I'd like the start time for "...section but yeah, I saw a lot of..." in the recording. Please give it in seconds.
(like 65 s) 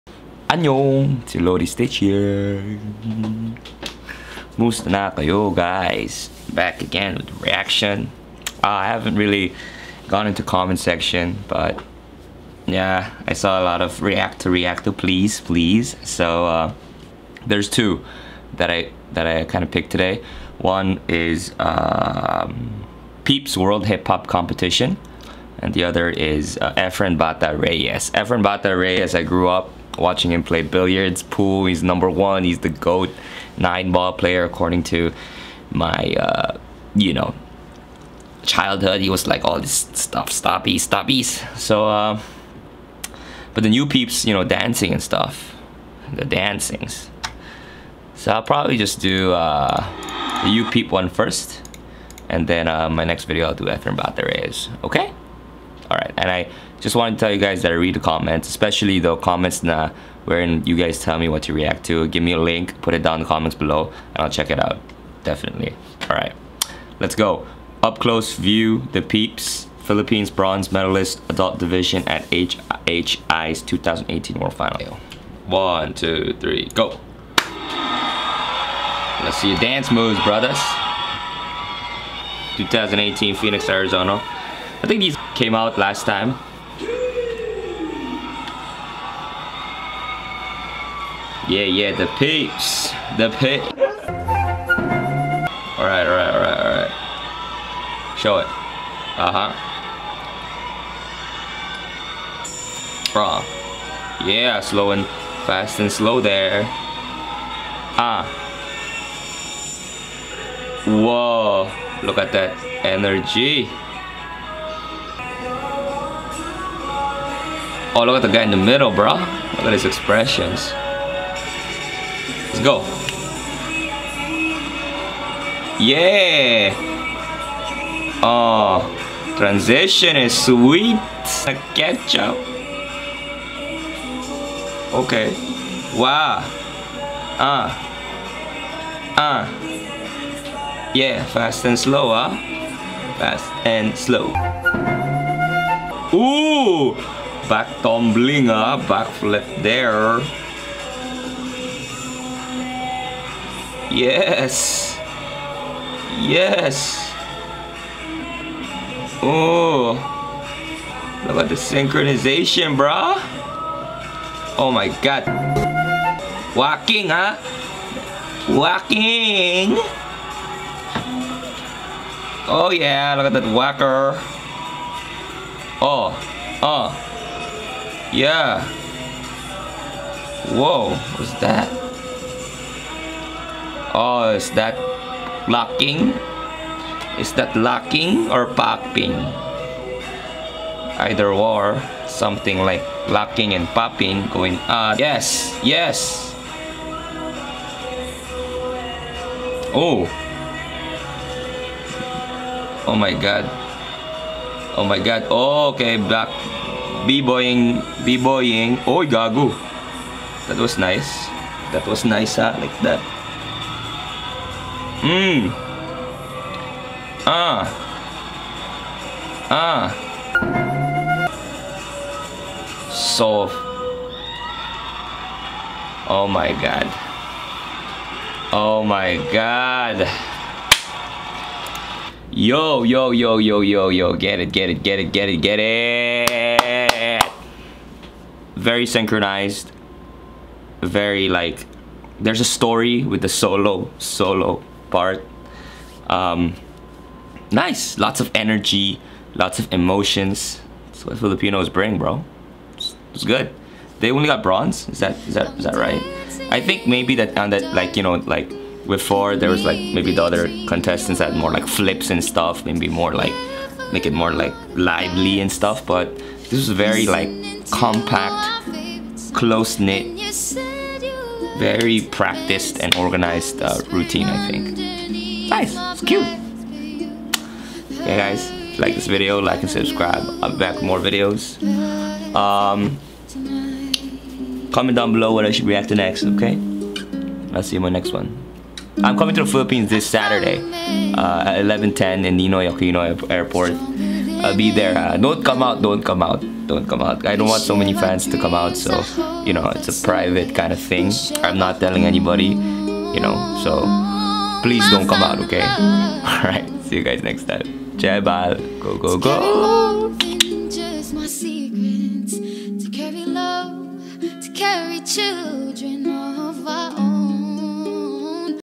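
10 s.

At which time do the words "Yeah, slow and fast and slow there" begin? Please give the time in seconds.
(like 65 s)
104 s.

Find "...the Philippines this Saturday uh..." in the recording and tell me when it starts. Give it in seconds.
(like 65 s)
289 s.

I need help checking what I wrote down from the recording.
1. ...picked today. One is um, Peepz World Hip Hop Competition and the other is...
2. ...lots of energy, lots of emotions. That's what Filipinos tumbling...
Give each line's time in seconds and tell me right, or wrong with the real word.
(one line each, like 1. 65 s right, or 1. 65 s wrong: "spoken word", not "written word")
1. 19 s right
2. 247 s wrong: "bring", not "tumbling".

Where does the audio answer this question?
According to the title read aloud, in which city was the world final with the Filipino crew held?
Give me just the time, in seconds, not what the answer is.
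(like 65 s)
83 s.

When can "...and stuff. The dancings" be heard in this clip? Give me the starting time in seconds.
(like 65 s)
44 s.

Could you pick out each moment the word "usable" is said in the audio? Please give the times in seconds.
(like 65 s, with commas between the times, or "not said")
not said.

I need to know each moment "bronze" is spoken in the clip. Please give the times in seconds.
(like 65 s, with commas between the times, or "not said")
70 s, 254 s.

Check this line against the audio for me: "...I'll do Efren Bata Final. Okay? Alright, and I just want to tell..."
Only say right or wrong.
wrong.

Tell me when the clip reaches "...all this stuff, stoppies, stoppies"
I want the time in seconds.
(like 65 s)
39 s.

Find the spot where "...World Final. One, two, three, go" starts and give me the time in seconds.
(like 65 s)
74 s.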